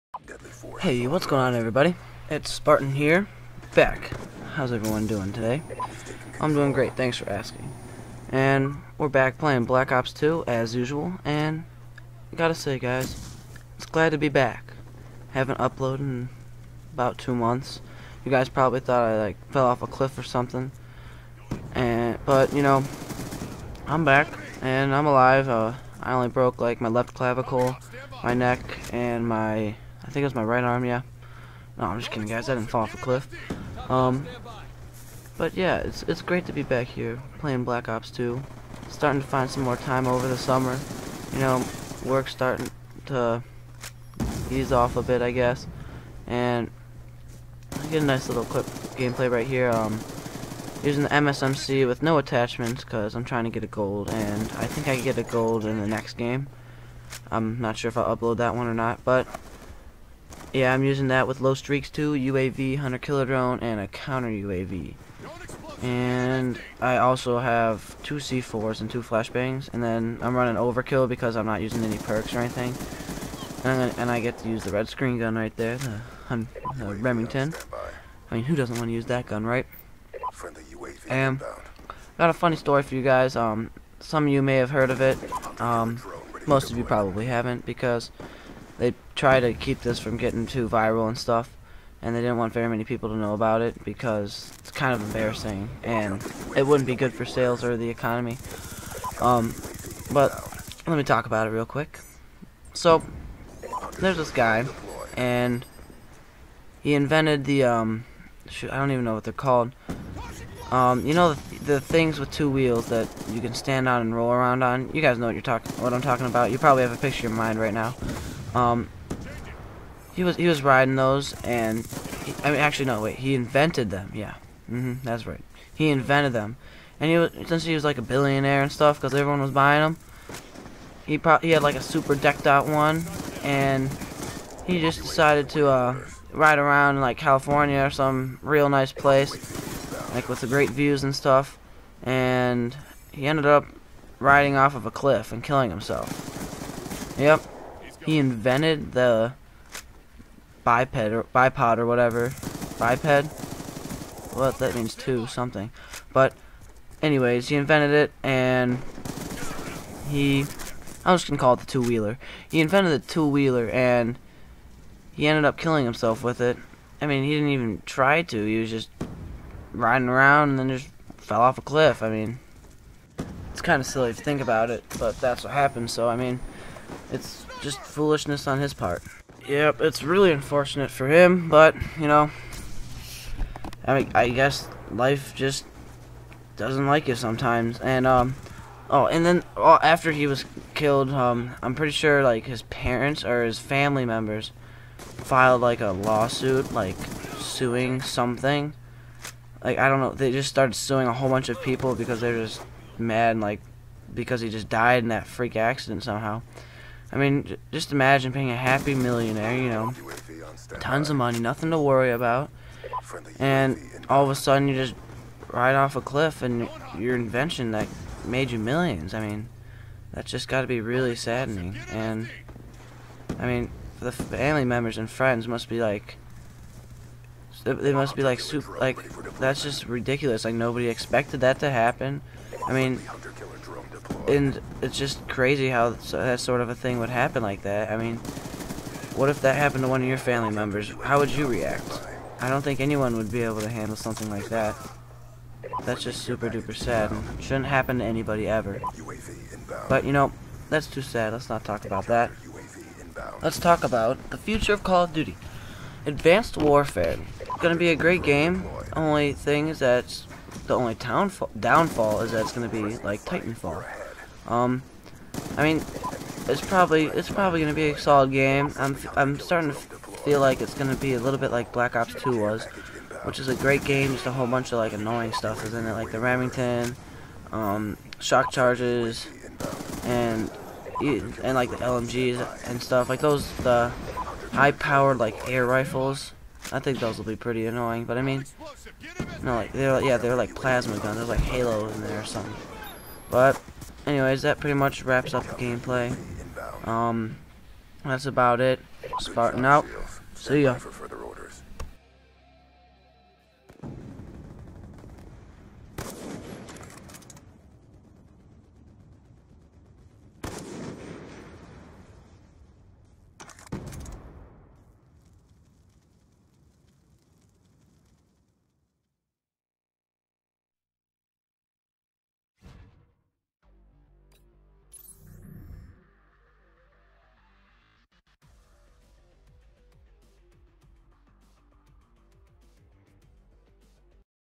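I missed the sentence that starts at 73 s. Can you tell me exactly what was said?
And, and I get to use the red screen gun right there, the, the Remington.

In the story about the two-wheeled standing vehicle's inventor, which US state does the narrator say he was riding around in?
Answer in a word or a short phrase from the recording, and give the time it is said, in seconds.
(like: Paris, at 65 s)
California, at 137 s.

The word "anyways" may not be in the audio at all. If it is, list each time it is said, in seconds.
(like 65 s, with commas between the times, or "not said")
157 s, 294 s.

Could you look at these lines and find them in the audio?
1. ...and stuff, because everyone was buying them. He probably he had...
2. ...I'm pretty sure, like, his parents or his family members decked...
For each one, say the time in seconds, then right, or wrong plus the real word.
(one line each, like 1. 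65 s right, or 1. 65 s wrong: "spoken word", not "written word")
1. 128 s right
2. 191 s wrong: "filed", not "decked".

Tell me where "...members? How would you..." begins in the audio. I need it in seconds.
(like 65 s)
240 s.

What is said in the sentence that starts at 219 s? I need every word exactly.
I mean, that's just got to be really saddening.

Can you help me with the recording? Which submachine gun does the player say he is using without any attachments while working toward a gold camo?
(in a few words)
MSMC.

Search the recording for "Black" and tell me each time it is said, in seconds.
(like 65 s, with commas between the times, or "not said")
9 s, 37 s, 271 s.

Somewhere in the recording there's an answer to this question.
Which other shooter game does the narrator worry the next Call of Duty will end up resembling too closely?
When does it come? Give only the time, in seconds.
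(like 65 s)
263 s.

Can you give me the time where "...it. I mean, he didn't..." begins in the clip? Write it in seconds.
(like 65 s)
166 s.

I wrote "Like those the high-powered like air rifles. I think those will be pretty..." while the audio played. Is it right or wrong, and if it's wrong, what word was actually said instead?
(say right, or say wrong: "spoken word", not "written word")
right.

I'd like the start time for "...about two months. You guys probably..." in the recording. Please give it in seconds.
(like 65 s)
16 s.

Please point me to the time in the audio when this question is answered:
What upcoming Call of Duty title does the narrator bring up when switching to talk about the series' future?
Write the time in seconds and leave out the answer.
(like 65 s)
256 s.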